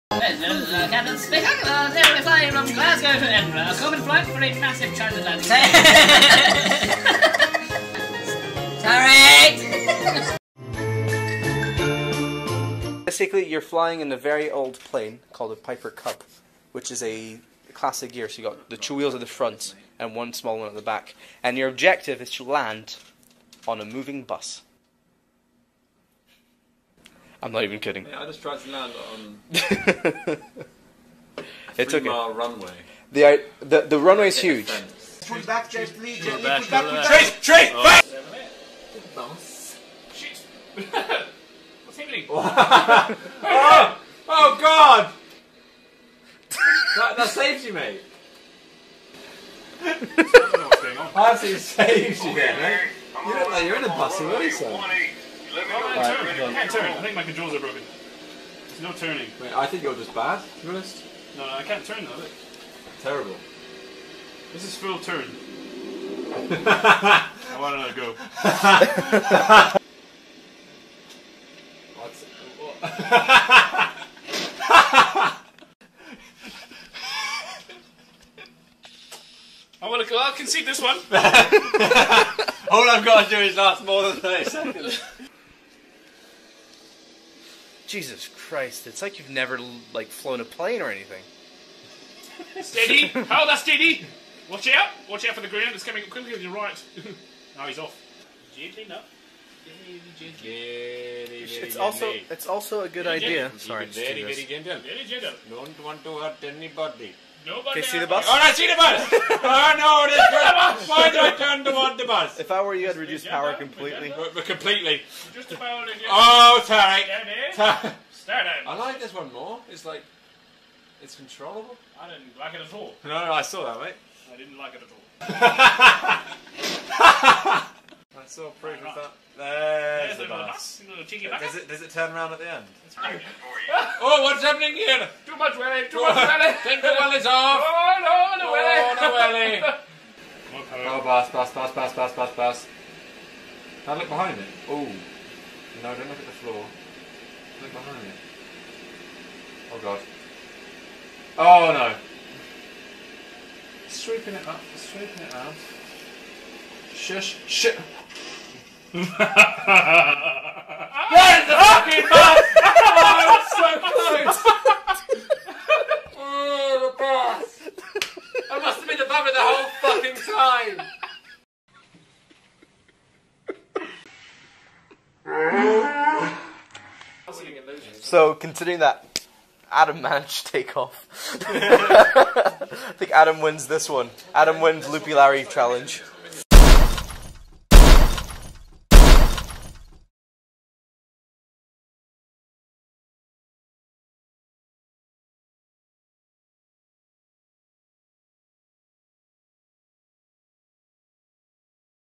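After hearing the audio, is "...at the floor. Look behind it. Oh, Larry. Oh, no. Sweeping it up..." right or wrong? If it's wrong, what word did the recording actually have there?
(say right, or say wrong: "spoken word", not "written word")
wrong: "God", not "Larry".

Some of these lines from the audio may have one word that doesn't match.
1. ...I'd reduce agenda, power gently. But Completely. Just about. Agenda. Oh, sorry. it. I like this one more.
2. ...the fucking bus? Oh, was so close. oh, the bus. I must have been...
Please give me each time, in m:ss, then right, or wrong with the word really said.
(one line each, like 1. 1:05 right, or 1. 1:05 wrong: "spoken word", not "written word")
1. 1:52 wrong: "completely", not "gently"
2. 2:39 right.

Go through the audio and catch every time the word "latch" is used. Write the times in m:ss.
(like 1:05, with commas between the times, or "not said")
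not said.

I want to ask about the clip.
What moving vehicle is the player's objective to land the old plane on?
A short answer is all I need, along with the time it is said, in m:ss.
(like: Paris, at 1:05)
A bus, at 0:23.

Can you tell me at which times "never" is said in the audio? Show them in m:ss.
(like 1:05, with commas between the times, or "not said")
1:29.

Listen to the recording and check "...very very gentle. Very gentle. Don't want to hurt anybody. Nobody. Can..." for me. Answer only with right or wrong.
right.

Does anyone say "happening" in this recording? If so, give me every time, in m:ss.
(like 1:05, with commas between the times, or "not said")
0:41, 2:14.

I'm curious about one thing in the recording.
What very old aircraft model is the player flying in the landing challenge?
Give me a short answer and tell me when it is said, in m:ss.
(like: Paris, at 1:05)
Piper Cub, at 0:15.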